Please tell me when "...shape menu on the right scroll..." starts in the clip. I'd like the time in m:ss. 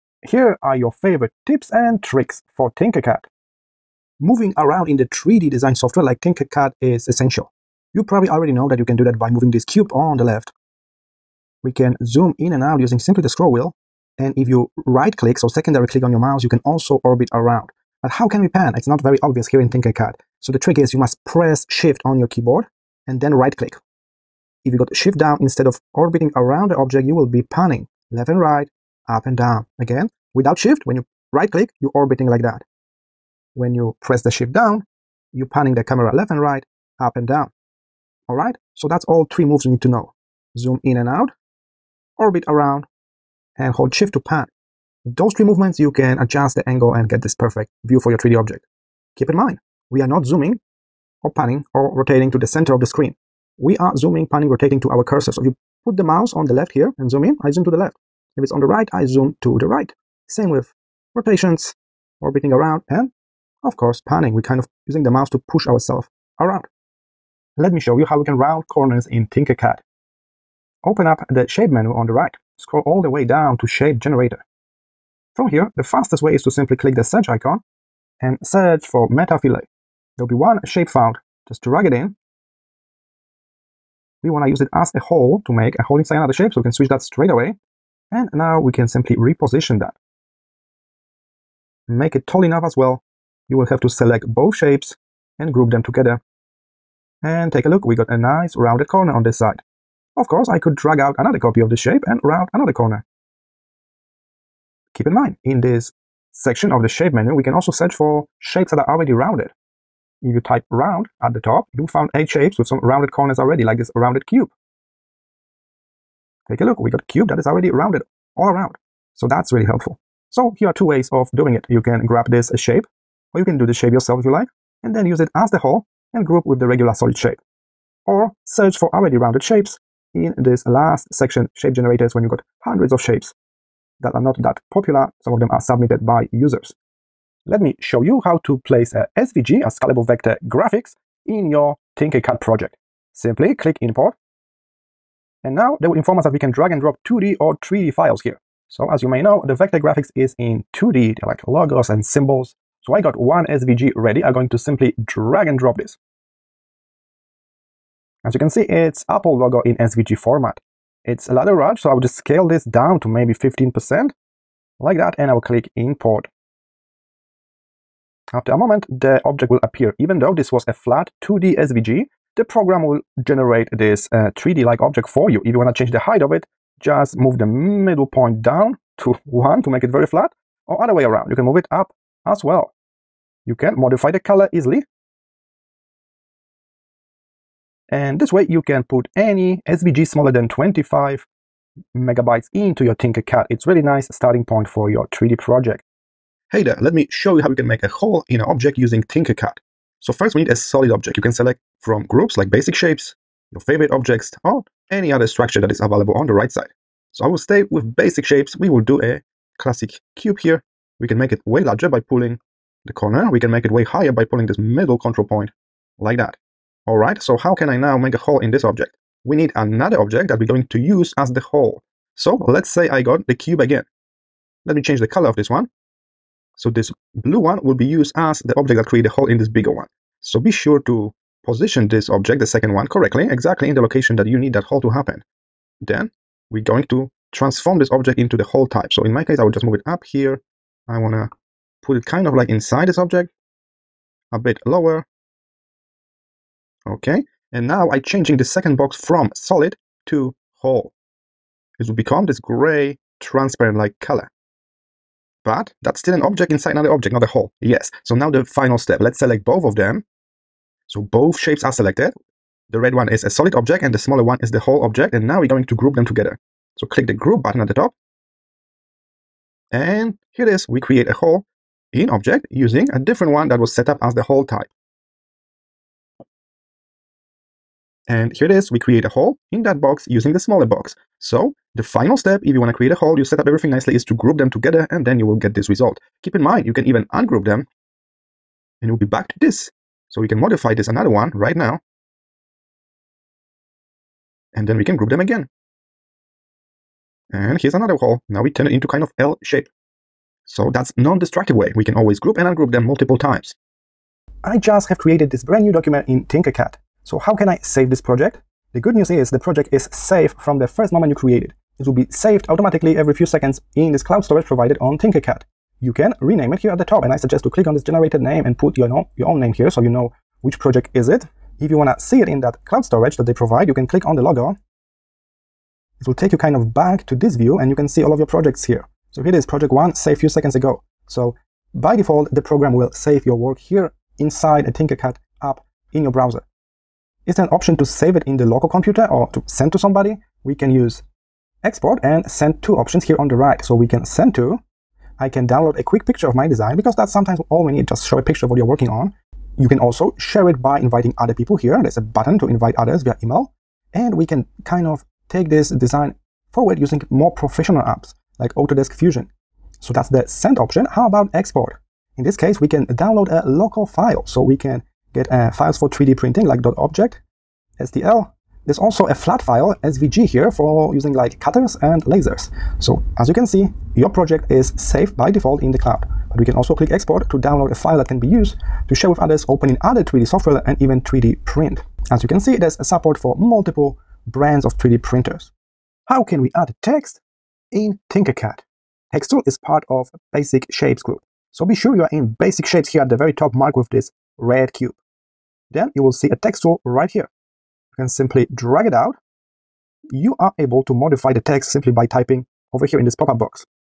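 1:11.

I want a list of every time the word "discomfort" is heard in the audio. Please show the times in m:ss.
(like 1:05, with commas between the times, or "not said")
not said.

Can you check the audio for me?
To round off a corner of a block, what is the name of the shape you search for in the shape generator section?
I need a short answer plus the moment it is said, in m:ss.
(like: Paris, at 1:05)
meta fillet, at 1:19.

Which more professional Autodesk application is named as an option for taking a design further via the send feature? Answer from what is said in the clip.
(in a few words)
Autodesk Fusion.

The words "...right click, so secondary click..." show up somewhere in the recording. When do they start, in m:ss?
0:14.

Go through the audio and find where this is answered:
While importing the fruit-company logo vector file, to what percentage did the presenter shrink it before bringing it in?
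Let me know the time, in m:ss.
2:43.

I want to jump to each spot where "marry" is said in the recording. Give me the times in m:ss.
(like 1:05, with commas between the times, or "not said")
not said.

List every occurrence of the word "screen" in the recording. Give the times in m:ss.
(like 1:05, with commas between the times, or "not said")
0:52.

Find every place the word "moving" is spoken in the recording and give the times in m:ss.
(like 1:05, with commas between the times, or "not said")
0:04, 0:09.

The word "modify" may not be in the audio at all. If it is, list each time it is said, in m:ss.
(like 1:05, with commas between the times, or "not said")
3:03, 4:50, 6:40.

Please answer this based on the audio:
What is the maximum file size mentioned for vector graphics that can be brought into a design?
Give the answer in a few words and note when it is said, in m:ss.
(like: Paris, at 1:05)
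25 megabytes, at 3:10.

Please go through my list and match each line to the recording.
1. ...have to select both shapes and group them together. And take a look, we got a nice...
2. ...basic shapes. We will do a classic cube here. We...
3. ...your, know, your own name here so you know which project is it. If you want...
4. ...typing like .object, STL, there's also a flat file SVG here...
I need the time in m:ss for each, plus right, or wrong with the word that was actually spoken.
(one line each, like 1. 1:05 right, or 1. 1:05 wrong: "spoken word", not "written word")
1. 1:33 right
2. 3:27 right
3. 5:18 right
4. 6:06 wrong: "printing", not "typing".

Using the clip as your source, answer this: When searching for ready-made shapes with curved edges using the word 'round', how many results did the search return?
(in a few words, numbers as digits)
8.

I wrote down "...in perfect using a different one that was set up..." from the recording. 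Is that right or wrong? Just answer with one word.
wrong.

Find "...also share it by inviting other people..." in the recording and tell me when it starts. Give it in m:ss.
5:49.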